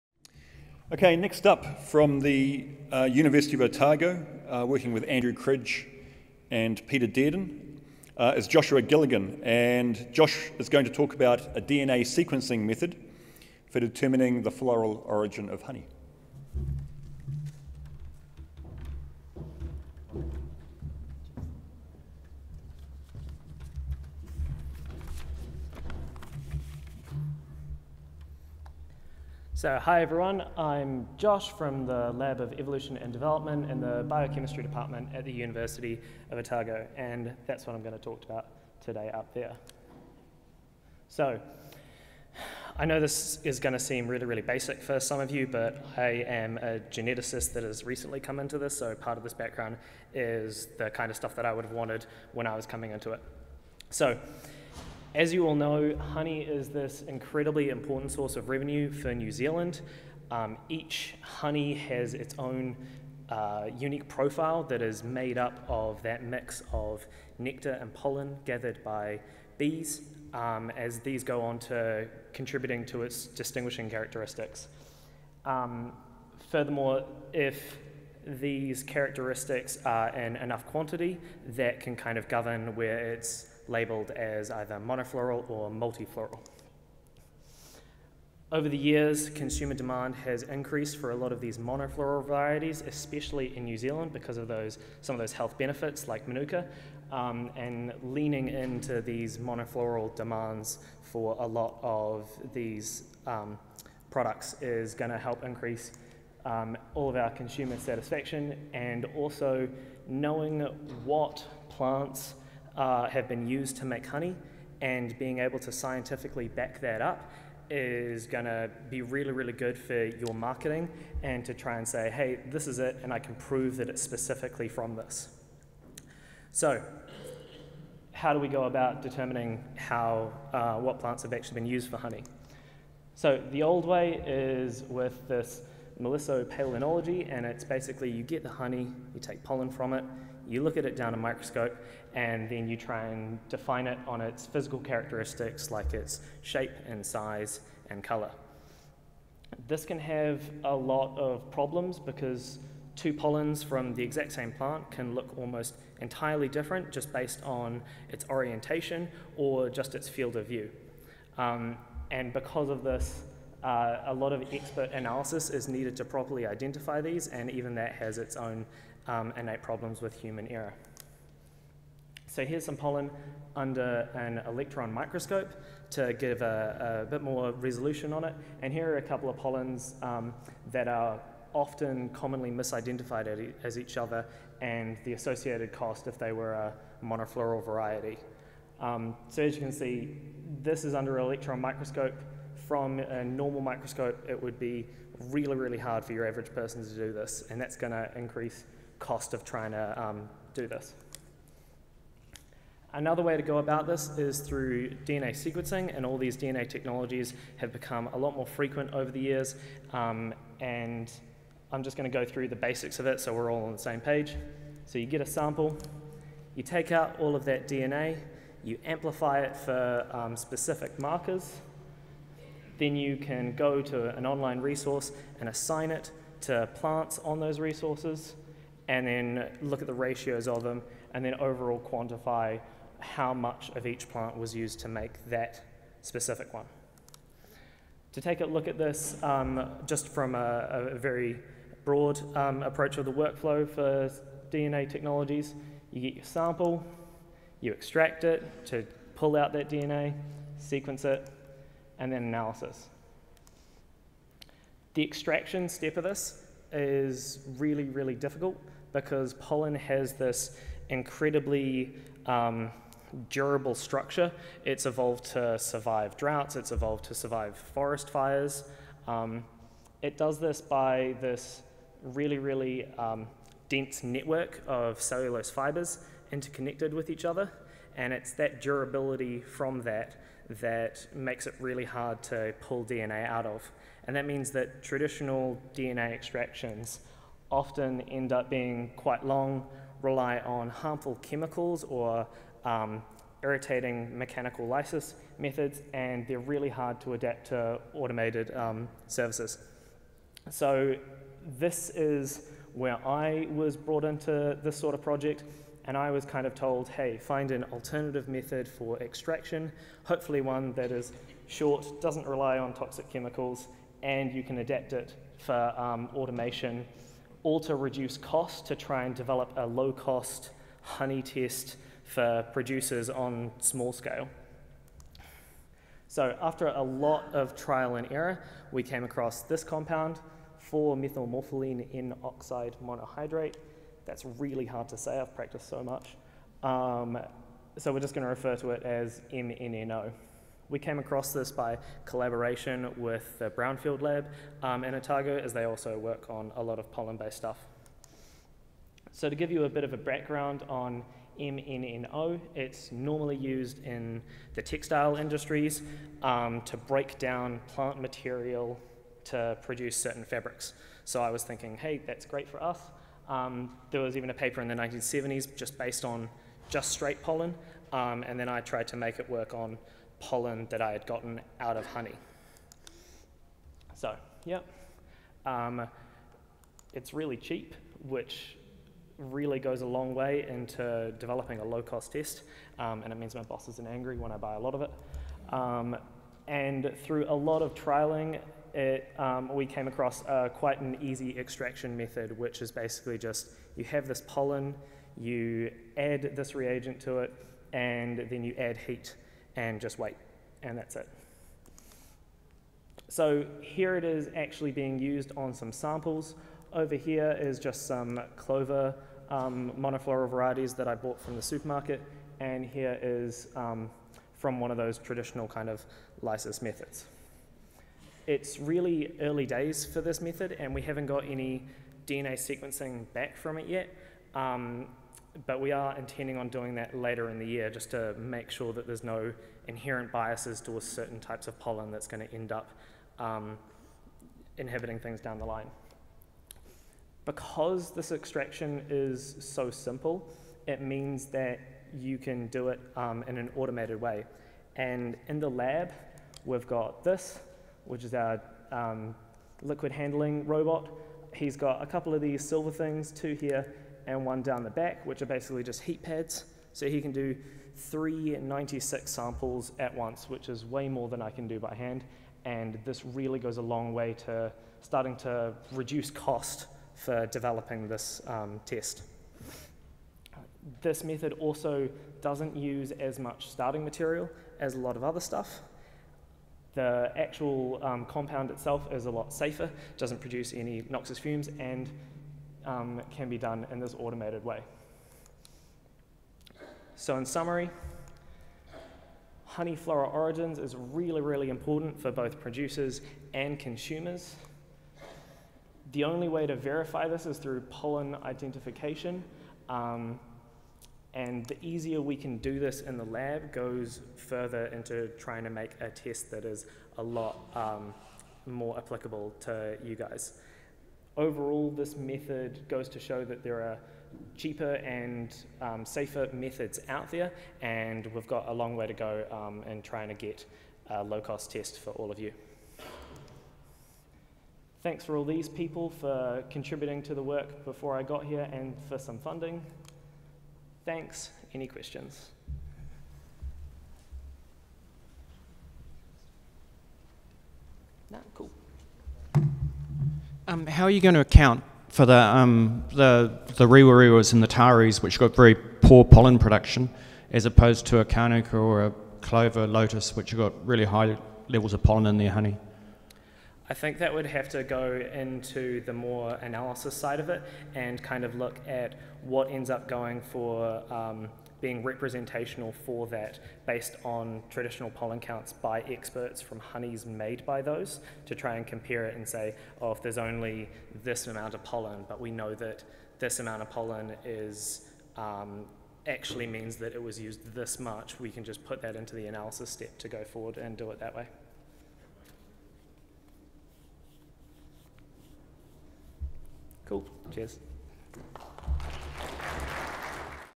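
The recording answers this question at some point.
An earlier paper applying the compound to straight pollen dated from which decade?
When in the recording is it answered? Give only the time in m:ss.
6:04.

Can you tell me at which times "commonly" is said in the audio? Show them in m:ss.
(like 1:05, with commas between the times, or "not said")
3:02.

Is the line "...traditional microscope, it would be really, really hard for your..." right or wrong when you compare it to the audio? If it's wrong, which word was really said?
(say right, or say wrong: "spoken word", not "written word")
wrong: "normal", not "traditional".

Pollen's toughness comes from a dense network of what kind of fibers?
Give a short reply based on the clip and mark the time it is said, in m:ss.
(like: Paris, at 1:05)
Cellulose, at 4:35.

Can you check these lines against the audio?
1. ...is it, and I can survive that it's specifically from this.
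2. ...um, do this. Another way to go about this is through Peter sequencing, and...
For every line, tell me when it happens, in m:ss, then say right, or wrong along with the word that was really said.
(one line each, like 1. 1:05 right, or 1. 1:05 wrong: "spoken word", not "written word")
1. 2:02 wrong: "prove", not "survive"
2. 3:20 wrong: "DNA", not "Peter".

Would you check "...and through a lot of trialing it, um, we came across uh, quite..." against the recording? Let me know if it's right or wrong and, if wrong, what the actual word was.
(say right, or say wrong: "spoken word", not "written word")
right.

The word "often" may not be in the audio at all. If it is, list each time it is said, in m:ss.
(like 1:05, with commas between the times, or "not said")
3:01, 4:47.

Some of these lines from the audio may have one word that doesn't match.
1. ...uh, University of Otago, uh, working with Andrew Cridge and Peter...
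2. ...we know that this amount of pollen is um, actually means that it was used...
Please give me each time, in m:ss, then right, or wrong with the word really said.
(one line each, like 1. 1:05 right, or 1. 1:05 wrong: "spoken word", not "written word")
1. 0:02 right
2. 9:32 right.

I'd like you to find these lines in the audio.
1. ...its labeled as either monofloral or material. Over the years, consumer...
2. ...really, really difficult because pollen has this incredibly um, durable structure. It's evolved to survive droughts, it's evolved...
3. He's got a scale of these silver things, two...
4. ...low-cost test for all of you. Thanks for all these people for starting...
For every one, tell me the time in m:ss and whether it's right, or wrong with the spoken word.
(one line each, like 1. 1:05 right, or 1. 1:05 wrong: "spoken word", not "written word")
1. 1:23 wrong: "multifloral", not "material"
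2. 4:17 right
3. 7:31 wrong: "couple", not "scale"
4. 8:41 wrong: "contributing", not "starting".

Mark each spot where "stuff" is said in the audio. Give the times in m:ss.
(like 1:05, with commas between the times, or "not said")
0:51, 5:47, 7:55.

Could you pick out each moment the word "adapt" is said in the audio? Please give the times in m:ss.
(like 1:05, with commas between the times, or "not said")
4:57, 5:14.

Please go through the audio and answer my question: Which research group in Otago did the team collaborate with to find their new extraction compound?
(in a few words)
Brownfield Lab.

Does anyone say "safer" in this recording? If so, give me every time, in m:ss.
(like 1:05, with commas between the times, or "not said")
7:59, 8:35.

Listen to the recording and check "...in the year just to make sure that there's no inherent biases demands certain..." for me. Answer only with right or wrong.
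wrong.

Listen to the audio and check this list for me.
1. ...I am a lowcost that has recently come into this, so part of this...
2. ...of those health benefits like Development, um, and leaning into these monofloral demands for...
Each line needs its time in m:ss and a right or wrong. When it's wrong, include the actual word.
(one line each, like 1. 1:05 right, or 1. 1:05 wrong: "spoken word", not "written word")
1. 0:45 wrong: "geneticist", not "lowcost"
2. 1:35 wrong: "Manuka", not "Development".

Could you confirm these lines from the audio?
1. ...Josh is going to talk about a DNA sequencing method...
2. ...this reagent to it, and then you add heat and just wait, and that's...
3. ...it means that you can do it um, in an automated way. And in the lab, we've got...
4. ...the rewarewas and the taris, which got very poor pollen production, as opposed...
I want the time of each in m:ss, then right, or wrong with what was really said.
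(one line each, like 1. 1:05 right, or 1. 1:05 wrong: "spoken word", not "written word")
1. 0:10 right
2. 6:36 right
3. 7:20 right
4. 9:03 right.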